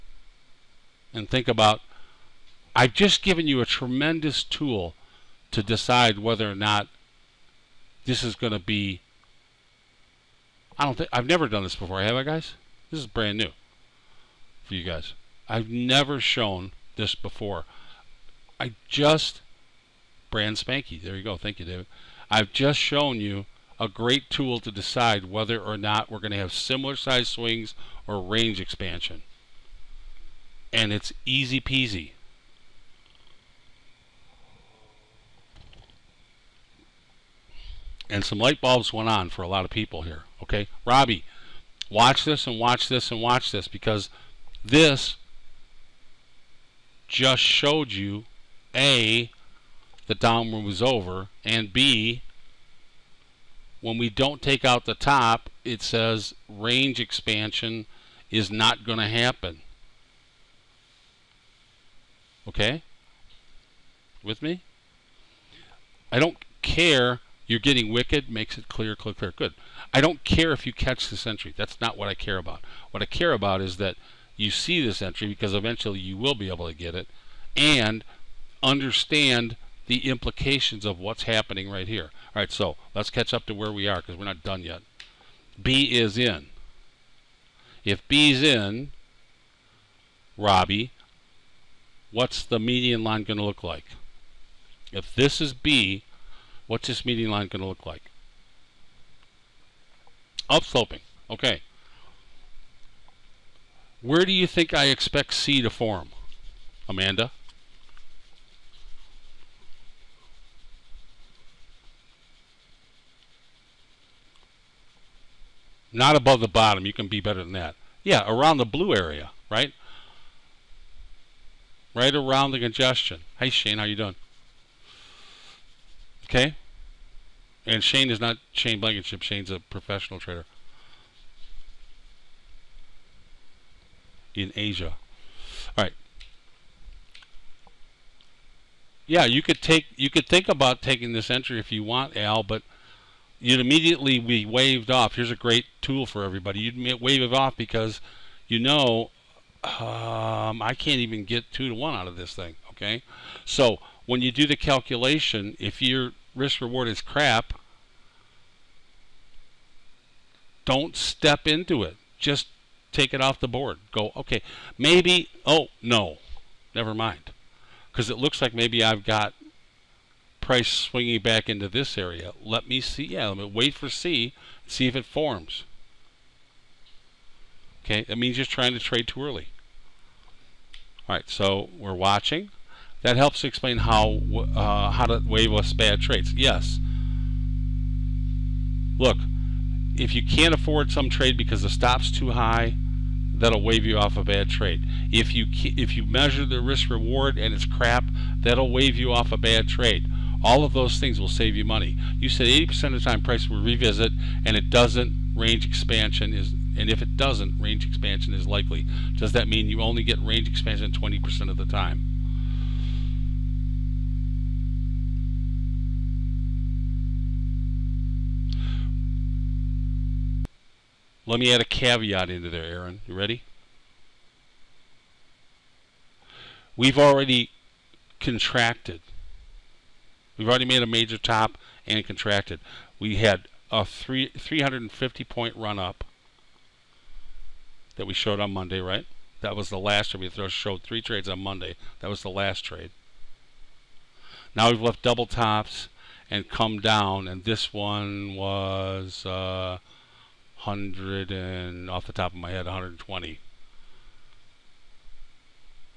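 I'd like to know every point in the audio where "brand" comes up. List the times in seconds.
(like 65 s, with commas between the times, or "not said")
13 s, 20 s.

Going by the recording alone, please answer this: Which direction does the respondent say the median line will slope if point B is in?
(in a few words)
Upsloping.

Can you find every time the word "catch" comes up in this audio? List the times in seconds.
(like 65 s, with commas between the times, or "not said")
70 s, 83 s.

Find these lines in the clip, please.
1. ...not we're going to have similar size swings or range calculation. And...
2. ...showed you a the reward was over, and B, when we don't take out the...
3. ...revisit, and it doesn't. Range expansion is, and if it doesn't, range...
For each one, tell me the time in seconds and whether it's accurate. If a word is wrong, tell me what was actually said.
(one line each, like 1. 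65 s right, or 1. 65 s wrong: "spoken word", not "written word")
1. 25 s wrong: "expansion", not "calculation"
2. 47 s wrong: "downward", not "reward"
3. 203 s right.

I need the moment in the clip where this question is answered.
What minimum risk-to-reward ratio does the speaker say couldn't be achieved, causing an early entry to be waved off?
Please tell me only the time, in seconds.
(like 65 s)
151 s.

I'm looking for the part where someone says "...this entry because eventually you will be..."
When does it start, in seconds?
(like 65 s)
74 s.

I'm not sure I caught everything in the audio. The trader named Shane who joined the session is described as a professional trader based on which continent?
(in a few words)
Asia.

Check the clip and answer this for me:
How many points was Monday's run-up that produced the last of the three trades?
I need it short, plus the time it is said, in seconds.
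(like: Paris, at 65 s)
350, at 234 s.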